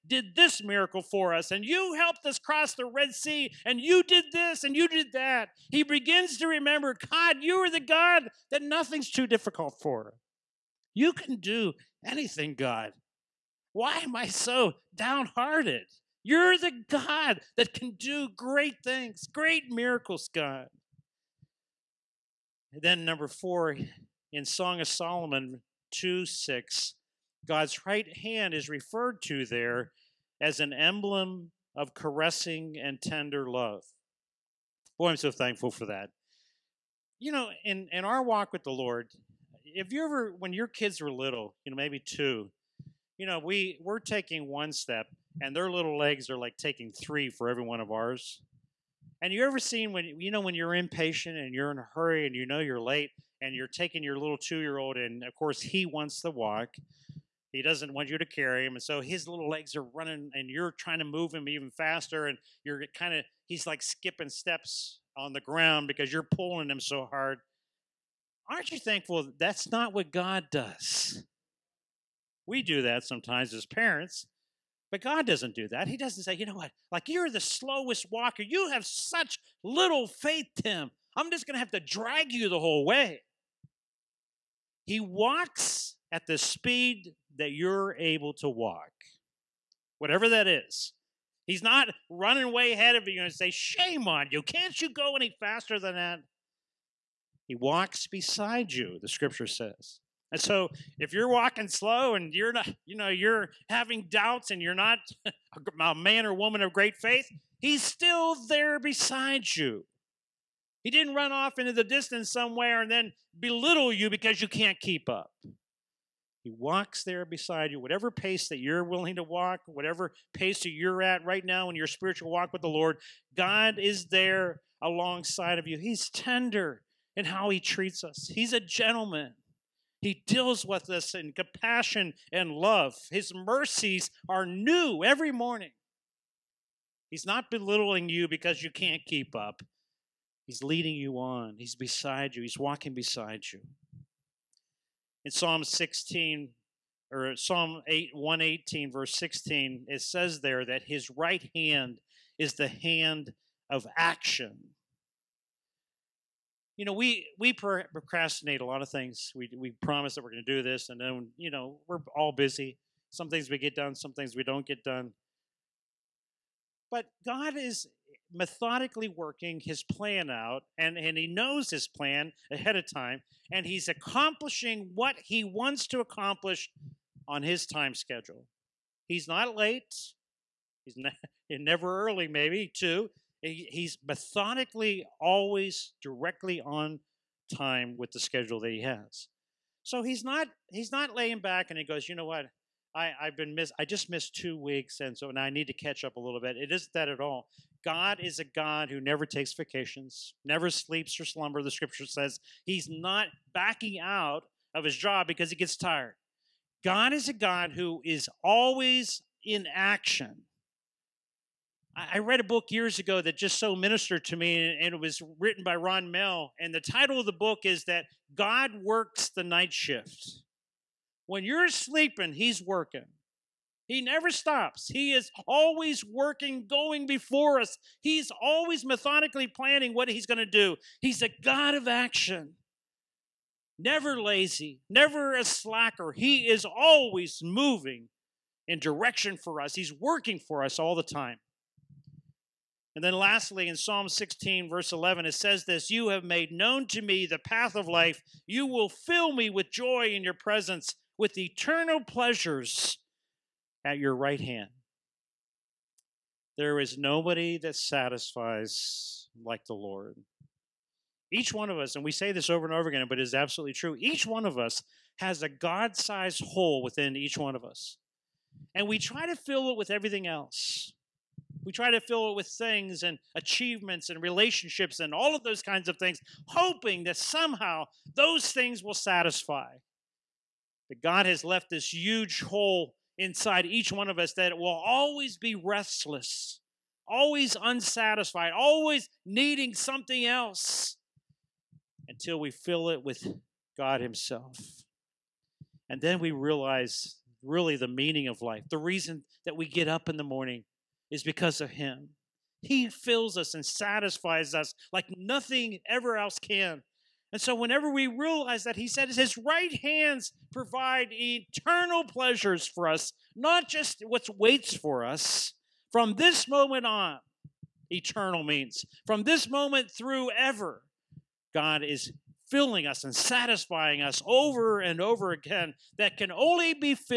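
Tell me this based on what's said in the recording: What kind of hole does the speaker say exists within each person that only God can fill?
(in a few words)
God sized.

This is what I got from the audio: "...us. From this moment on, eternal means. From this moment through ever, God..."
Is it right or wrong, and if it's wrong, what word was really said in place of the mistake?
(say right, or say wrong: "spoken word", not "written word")
right.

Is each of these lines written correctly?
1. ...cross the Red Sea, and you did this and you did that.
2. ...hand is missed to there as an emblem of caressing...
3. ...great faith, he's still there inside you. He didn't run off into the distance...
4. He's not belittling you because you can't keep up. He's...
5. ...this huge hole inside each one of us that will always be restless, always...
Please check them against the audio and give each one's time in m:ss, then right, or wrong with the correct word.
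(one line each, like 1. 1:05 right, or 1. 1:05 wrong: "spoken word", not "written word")
1. 0:02 right
2. 0:28 wrong: "referred", not "missed"
3. 1:46 wrong: "beside", not "inside"
4. 2:17 right
5. 4:41 right.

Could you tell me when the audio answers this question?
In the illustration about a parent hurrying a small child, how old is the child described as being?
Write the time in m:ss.
0:54.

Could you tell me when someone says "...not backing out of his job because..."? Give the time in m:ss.
3:22.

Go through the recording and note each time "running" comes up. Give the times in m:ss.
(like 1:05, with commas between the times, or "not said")
0:59, 1:32.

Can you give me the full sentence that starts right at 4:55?
And then we realize really the meaning of life, the reason that we get up in the morning, is because of Him.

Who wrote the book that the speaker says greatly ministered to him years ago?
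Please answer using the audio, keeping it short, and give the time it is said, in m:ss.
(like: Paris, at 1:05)
Ron Mehl, at 3:35.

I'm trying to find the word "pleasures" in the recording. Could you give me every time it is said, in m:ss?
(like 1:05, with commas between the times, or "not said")
4:11, 5:12.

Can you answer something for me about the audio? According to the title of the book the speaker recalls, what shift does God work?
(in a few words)
The night shift.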